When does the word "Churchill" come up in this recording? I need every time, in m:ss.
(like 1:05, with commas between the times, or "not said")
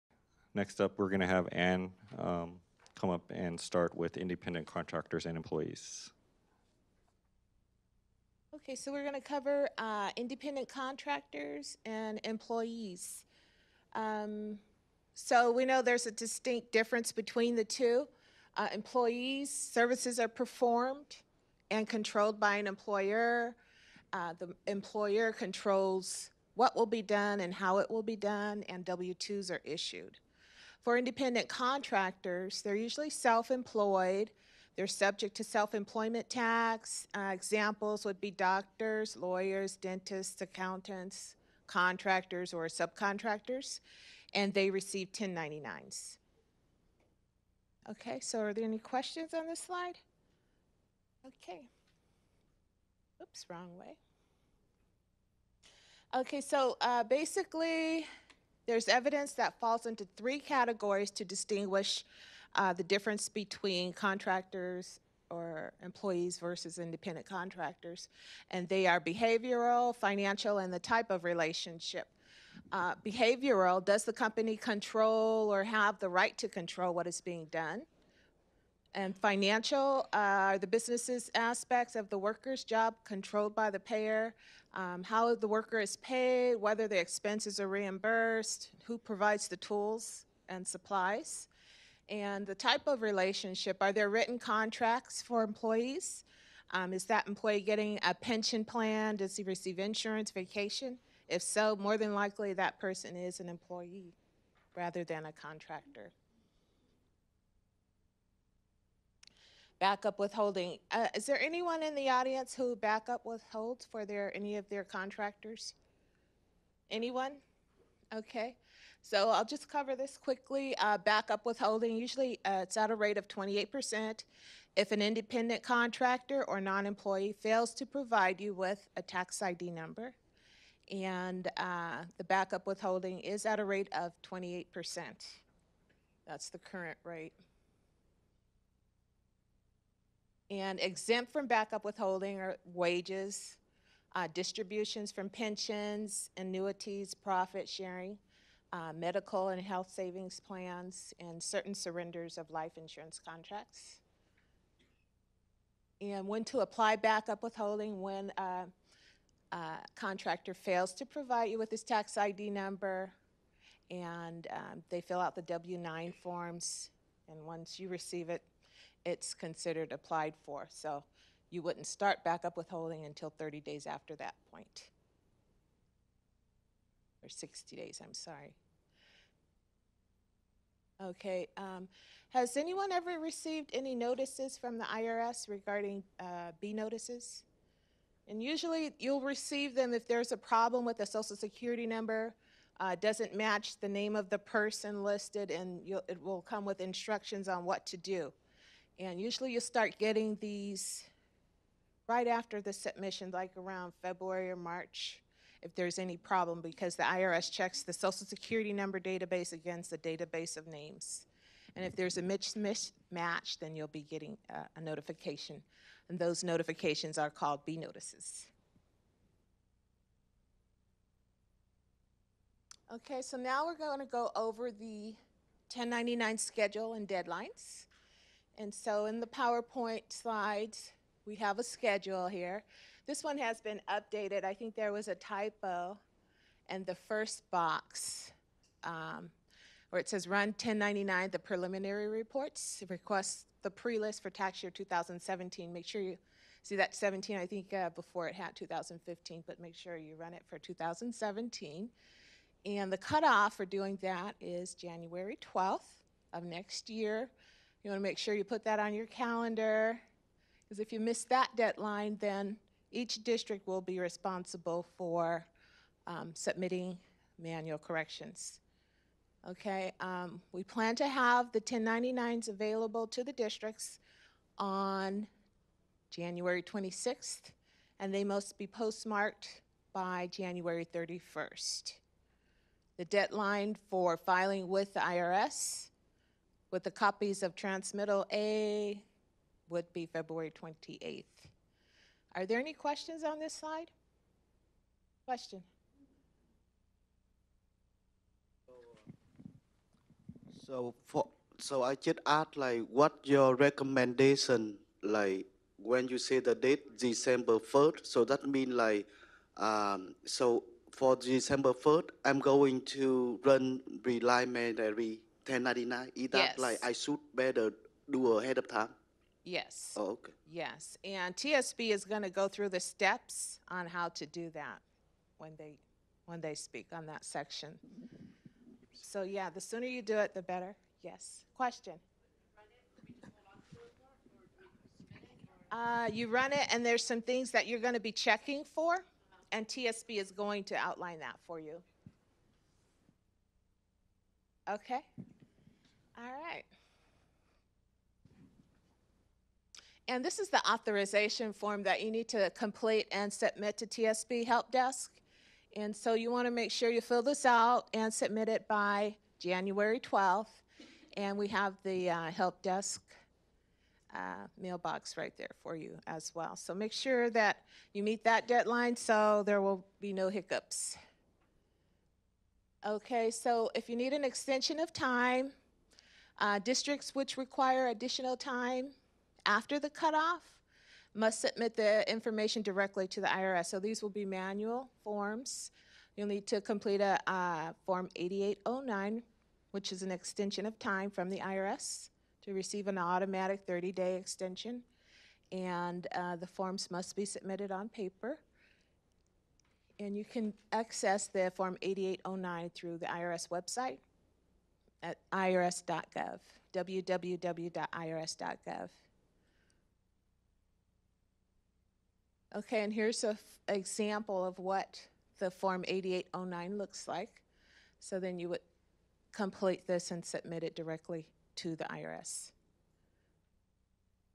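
not said.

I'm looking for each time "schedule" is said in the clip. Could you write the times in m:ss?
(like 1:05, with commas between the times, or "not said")
3:46, 3:51.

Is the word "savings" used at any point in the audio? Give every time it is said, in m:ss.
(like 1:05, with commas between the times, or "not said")
2:29.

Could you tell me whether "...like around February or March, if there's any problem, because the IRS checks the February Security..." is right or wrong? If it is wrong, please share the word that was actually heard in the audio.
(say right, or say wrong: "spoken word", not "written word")
wrong: "Social", not "February".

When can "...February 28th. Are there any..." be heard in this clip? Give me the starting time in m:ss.
4:50.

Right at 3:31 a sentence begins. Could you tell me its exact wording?
And if there's a mismatch, then you'll be getting a, uh, a notification.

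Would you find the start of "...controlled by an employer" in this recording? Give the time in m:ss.
0:21.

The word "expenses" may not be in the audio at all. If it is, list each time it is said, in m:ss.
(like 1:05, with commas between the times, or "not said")
1:26.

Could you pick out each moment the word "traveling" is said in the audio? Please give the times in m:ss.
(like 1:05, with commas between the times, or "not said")
not said.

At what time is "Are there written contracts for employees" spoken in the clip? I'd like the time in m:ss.
1:33.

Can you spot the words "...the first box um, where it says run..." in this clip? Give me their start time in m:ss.
3:56.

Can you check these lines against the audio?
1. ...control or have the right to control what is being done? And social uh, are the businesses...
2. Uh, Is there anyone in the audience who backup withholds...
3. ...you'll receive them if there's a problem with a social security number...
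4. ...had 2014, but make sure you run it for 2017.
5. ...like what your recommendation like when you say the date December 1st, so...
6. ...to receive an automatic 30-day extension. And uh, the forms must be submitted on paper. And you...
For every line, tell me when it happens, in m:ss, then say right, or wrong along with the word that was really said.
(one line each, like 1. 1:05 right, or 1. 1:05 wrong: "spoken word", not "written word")
1. 1:14 wrong: "financial", not "social"
2. 1:50 right
3. 3:08 right
4. 4:08 wrong: "2015", not "2014"
5. 5:02 right
6. 6:32 right.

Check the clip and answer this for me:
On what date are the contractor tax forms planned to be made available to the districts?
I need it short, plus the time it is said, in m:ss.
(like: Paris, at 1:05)
January 26th, at 4:36.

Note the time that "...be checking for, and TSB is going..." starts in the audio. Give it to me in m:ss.
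5:37.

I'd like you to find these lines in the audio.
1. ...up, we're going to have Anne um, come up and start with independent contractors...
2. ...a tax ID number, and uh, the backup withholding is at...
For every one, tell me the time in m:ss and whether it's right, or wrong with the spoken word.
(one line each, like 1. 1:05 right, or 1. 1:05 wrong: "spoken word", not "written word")
1. 0:00 right
2. 2:08 right.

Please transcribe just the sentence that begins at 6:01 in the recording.
And we have the uh, Help Desk uh, mailbox right there for you as well.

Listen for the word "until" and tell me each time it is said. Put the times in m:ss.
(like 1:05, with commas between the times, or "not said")
2:53.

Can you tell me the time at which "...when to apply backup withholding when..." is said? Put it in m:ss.
2:36.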